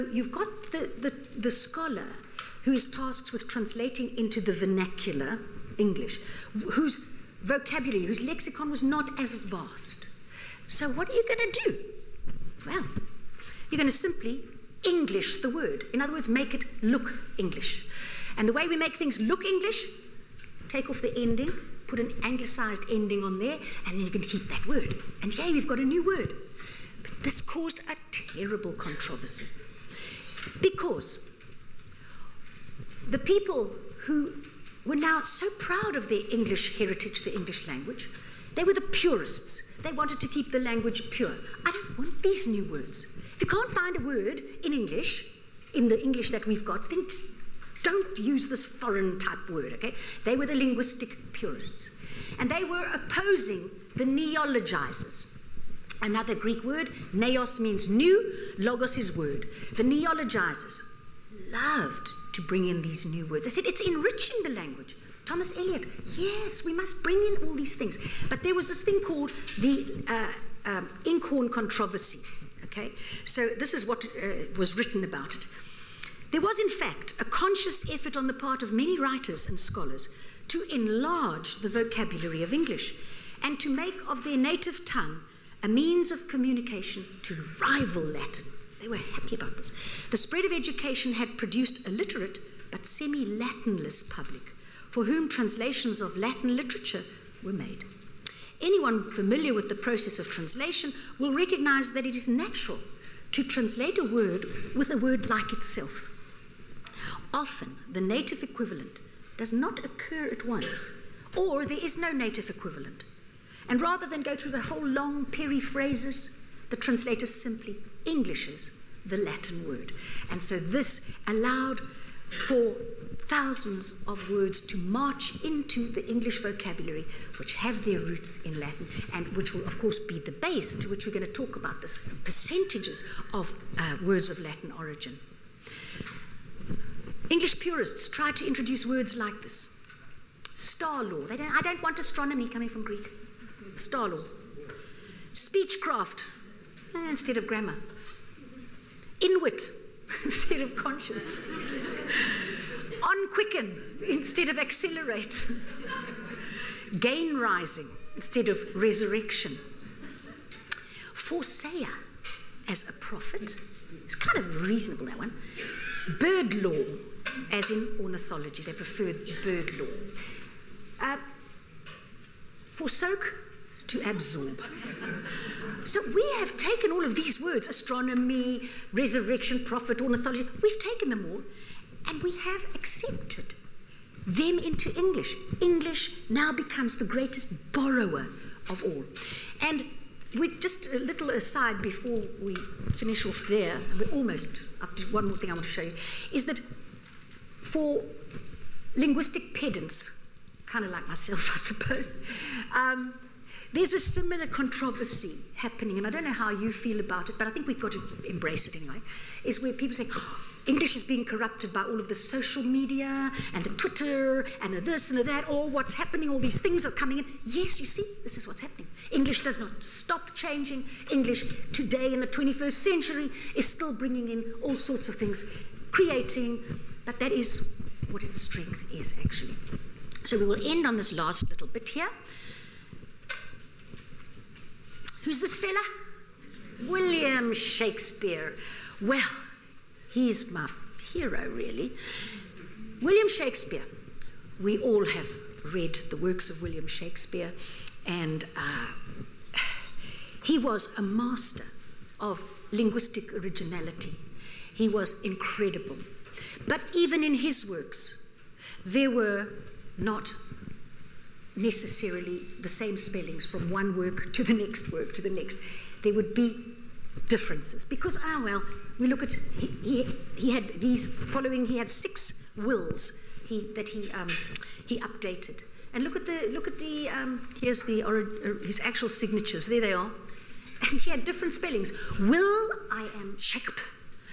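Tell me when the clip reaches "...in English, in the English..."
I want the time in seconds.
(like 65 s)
44 s.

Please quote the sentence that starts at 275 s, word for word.
And look at the, look at the um, here's the, or, uh, his actual signatures, there they are.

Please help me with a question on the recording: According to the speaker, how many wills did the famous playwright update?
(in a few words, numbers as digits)
6.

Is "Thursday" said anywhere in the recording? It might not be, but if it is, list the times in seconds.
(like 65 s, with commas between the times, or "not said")
not said.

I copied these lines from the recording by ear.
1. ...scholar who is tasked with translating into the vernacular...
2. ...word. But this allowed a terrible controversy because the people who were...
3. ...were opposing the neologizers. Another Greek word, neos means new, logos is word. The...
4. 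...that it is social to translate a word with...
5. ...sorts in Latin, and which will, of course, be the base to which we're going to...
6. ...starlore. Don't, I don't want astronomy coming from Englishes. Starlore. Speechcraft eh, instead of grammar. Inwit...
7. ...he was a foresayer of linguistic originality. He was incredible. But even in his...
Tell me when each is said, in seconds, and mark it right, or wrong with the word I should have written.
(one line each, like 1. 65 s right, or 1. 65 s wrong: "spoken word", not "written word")
1. 1 s right
2. 26 s wrong: "caused", not "allowed"
3. 52 s right
4. 101 s wrong: "natural", not "social"
5. 127 s wrong: "roots", not "sorts"
6. 140 s wrong: "Greek", not "Englishes"
7. 250 s wrong: "master", not "foresayer".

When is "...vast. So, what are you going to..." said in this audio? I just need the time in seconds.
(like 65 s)
9 s.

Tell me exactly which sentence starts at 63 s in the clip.
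I said, it's enriching the language.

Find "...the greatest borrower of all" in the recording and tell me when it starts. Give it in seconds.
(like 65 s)
186 s.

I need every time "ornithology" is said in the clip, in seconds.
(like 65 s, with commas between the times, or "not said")
168 s, 180 s.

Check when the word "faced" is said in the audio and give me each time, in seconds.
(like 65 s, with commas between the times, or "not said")
not said.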